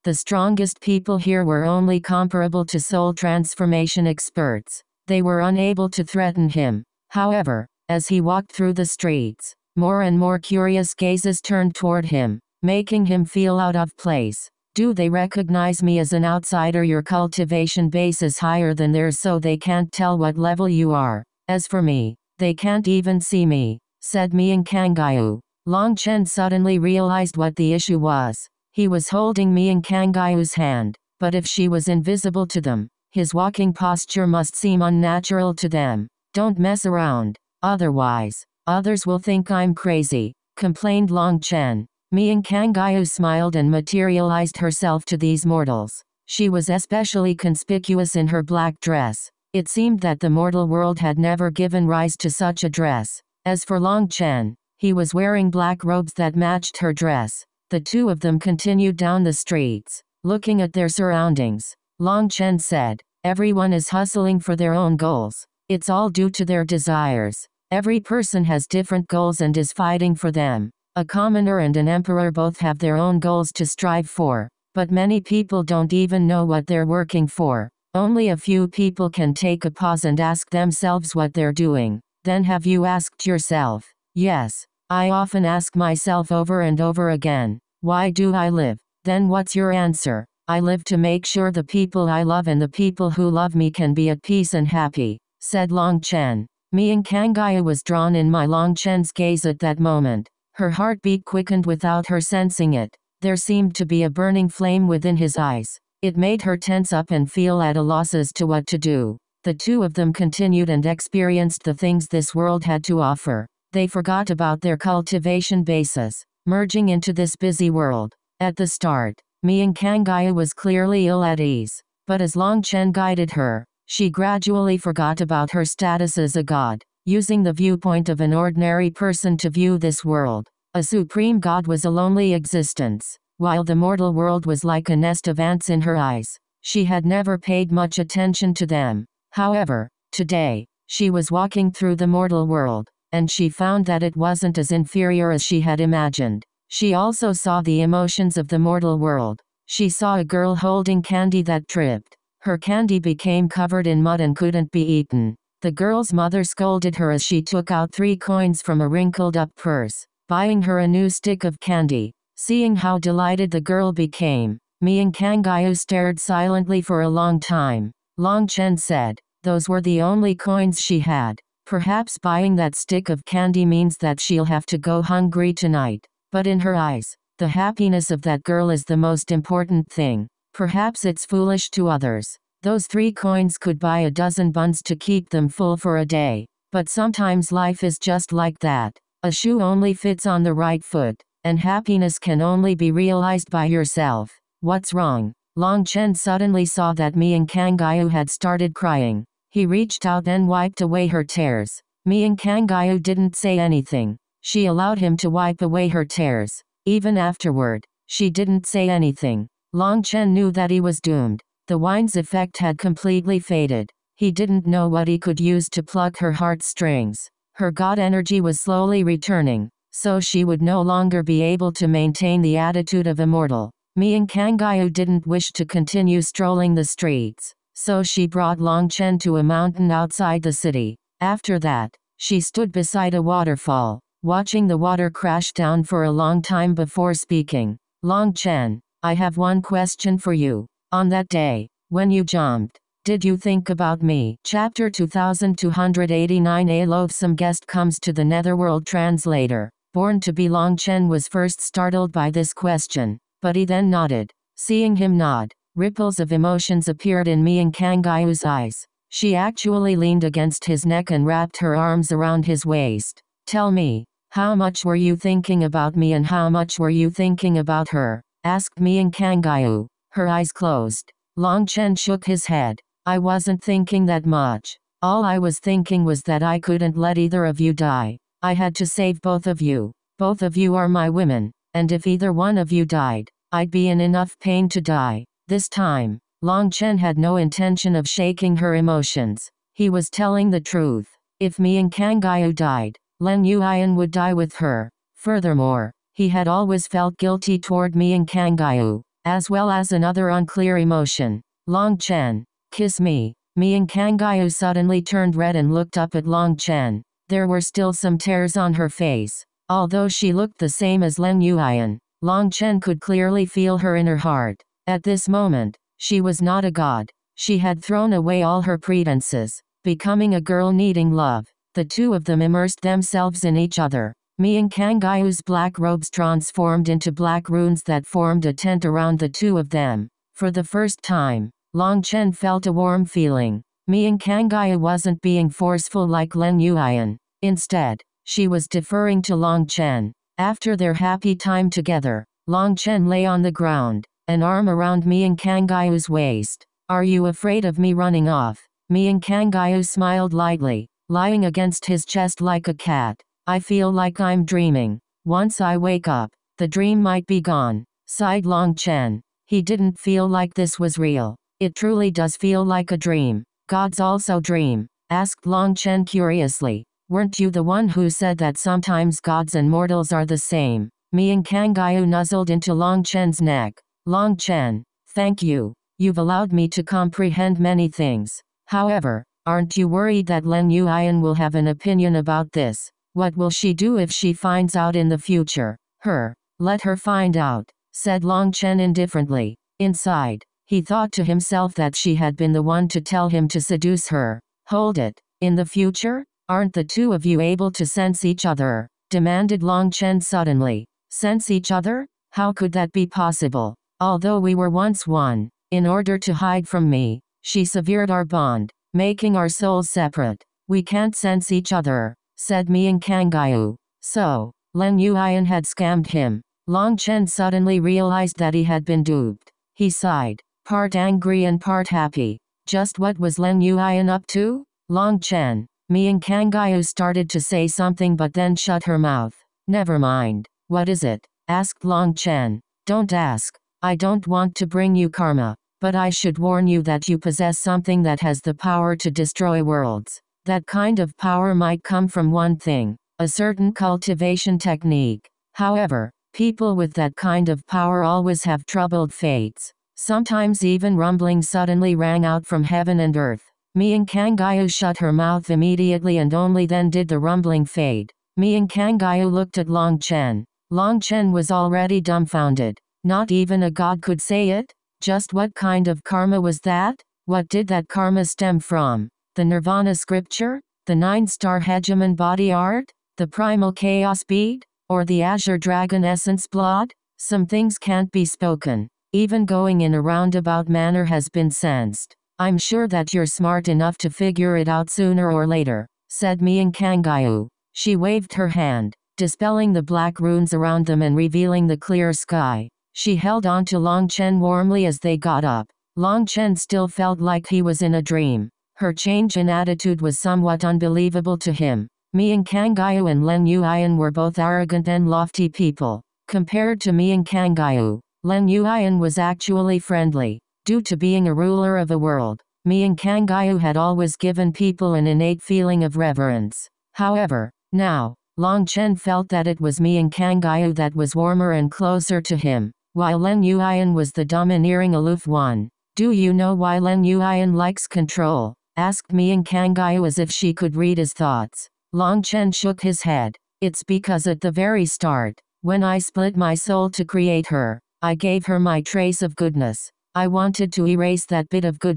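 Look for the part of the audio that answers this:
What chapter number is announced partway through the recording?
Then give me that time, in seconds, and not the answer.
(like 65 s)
244 s.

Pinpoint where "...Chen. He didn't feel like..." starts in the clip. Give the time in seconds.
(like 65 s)
358 s.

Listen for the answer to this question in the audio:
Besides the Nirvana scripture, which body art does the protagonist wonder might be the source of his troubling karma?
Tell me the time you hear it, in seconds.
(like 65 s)
470 s.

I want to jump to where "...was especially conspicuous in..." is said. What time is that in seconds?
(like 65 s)
46 s.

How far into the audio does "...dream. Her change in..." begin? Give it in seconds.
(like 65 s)
498 s.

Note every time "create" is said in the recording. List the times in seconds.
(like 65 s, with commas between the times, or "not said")
537 s.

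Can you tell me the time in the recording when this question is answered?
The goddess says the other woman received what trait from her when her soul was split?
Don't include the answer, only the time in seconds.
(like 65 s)
538 s.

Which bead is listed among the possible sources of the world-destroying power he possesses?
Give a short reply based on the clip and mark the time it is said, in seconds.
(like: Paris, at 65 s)
Primal chaos bead, at 473 s.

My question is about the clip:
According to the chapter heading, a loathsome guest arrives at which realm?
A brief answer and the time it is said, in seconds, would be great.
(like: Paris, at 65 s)
The netherworld, at 248 s.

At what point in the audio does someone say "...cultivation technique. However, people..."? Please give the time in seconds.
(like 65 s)
443 s.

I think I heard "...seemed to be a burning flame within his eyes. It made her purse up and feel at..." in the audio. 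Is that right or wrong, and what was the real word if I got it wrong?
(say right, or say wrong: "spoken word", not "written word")
wrong: "tense", not "purse".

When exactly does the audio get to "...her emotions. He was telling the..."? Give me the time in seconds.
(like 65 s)
288 s.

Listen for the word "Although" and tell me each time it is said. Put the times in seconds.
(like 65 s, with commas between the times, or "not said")
309 s, 403 s.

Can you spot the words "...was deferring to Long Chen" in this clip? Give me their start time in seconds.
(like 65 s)
338 s.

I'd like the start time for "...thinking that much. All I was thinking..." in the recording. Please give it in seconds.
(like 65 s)
273 s.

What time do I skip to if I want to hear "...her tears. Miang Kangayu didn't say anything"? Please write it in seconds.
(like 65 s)
201 s.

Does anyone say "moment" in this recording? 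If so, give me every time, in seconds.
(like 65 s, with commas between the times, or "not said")
99 s, 315 s.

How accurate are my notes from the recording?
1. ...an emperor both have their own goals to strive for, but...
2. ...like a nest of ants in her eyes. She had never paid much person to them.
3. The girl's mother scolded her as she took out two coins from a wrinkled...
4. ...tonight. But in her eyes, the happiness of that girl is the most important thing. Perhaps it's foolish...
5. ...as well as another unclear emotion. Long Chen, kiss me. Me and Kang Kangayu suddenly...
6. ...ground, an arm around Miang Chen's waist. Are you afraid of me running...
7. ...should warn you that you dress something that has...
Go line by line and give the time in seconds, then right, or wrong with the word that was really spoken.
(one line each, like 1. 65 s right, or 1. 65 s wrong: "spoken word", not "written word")
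1. 71 s right
2. 134 s wrong: "attention", not "person"
3. 155 s wrong: "three", not "two"
4. 175 s right
5. 299 s right
6. 343 s wrong: "Kangyu", not "Chen"
7. 436 s wrong: "possess", not "dress".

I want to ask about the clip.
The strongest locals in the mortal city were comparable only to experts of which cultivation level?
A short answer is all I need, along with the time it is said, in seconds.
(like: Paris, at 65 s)
Soul transformation, at 2 s.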